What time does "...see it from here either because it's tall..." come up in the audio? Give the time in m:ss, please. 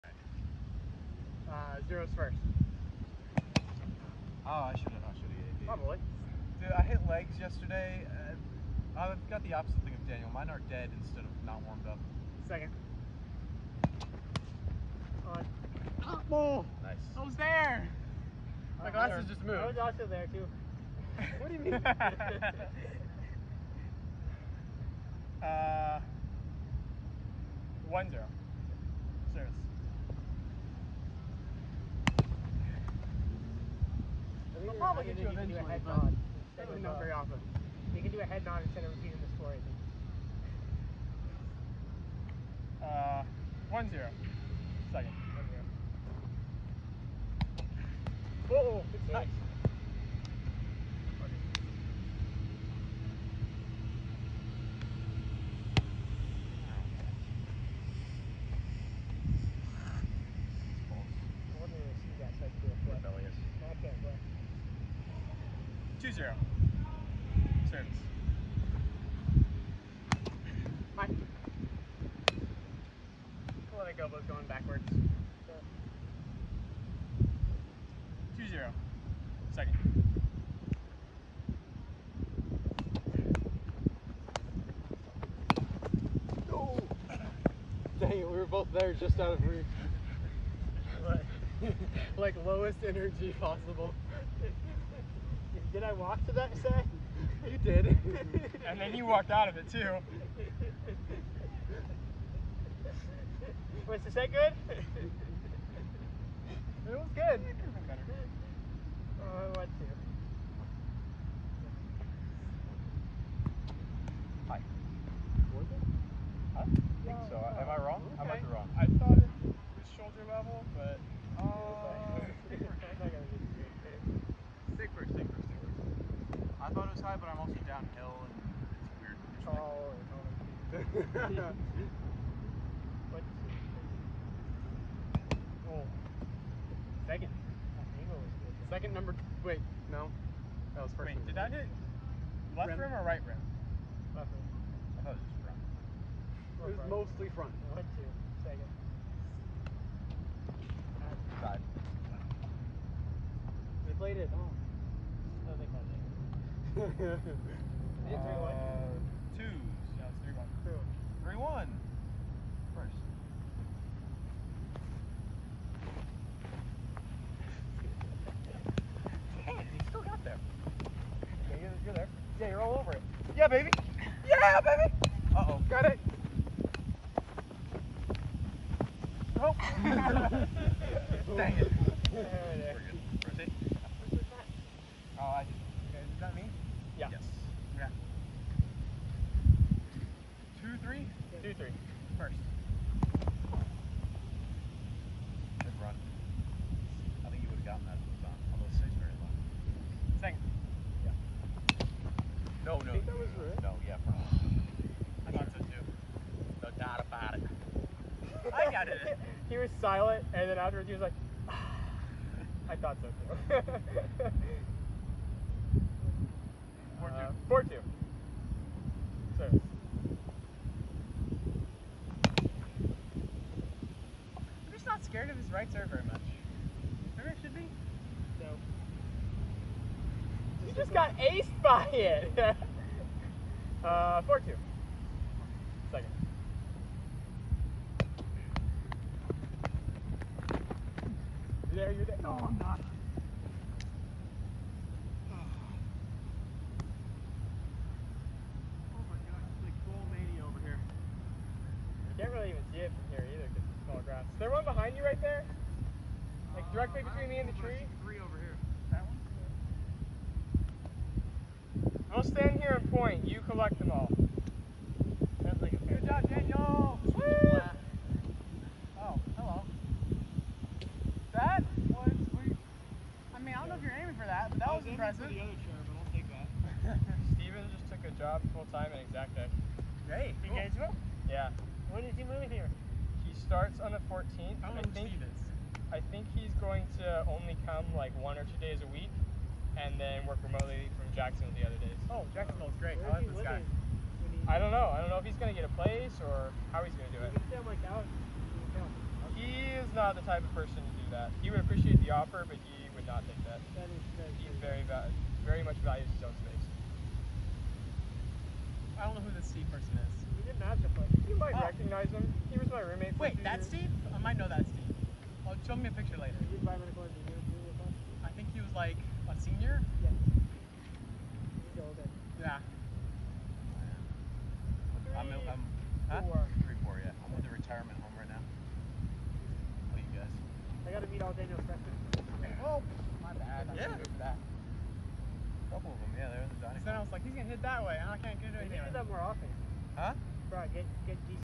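4:12.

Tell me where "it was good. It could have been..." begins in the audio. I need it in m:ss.
1:46.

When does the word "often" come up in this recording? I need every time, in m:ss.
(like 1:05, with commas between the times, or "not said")
0:37, 5:39.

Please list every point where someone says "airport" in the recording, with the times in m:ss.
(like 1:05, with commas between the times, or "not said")
not said.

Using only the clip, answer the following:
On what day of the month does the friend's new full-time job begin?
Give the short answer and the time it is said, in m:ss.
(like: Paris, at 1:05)
14th, at 4:44.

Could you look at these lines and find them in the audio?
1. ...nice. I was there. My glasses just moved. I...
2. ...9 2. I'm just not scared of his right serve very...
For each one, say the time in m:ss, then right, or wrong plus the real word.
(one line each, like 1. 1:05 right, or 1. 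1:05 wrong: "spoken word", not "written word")
1. 0:16 right
2. 3:37 wrong: "4", not "9".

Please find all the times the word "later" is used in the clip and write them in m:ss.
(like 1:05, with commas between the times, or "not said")
5:16.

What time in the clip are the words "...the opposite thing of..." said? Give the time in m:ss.
0:09.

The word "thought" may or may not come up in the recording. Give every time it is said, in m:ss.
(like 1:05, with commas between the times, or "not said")
2:25, 3:25, 3:32.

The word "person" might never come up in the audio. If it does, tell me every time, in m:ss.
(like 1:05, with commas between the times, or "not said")
5:00, 5:09.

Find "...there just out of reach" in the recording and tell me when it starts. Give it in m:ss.
1:28.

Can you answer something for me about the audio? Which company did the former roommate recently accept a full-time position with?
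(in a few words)
Exactech.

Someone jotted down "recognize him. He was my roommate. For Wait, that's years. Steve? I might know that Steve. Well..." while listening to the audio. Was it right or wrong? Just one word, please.
right.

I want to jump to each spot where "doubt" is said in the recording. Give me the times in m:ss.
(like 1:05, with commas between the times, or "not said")
3:26.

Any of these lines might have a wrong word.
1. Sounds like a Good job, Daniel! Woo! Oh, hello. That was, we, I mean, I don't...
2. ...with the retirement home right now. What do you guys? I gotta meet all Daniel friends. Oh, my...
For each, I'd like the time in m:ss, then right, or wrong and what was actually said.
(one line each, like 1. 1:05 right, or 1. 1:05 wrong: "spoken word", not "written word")
1. 4:25 right
2. 5:27 right.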